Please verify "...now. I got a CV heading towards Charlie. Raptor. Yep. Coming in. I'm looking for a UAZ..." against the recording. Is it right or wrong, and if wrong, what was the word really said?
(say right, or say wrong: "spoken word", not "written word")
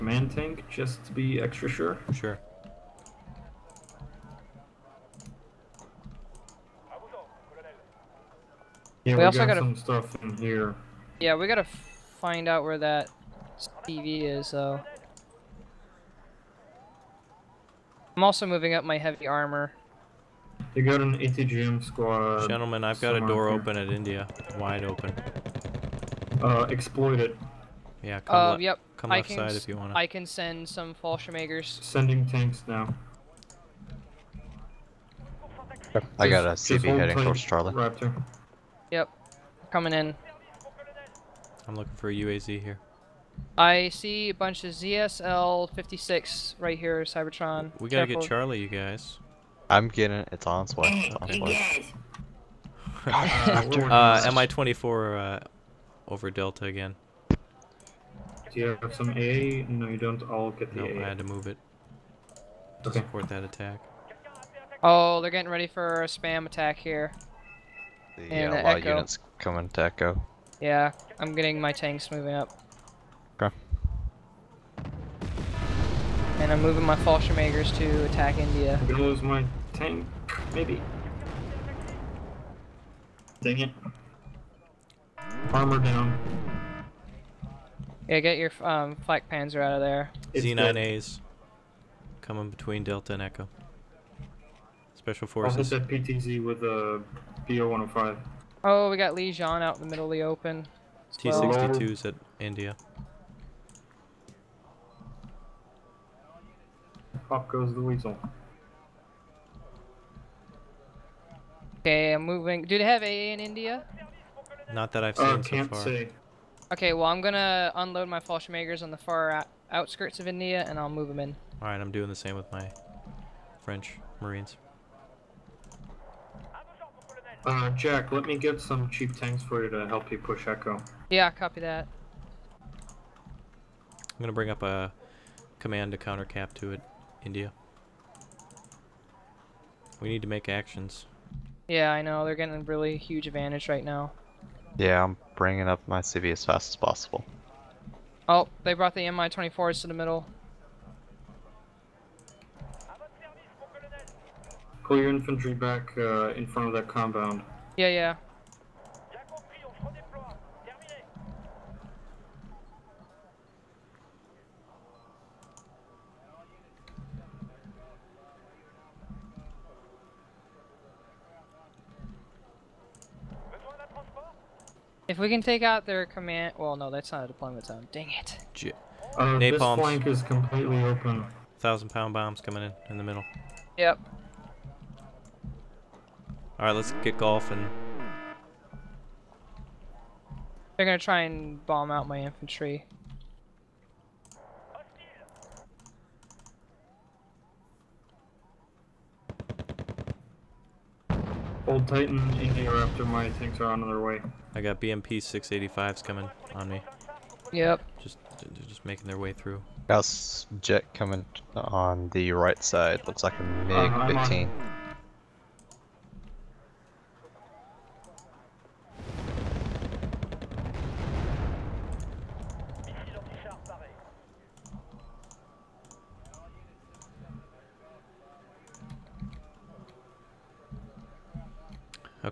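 right.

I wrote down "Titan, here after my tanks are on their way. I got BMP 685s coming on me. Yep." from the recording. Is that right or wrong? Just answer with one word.
right.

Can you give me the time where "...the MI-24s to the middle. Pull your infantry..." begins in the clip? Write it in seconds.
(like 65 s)
148 s.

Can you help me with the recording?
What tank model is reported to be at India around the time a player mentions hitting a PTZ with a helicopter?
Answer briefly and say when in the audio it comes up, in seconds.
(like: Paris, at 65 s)
T-62, at 101 s.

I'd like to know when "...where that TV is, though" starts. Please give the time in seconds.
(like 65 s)
12 s.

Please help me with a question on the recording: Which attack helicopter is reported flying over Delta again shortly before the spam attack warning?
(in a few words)
MI24.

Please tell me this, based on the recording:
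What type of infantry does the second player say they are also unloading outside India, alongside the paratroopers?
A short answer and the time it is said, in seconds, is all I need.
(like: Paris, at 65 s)
French Marines, at 123 s.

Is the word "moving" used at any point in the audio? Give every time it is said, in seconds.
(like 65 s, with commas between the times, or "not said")
18 s, 72 s, 76 s, 112 s.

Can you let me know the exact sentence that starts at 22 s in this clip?
Gentlemen, I've got a door here.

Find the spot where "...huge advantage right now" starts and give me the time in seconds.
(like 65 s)
142 s.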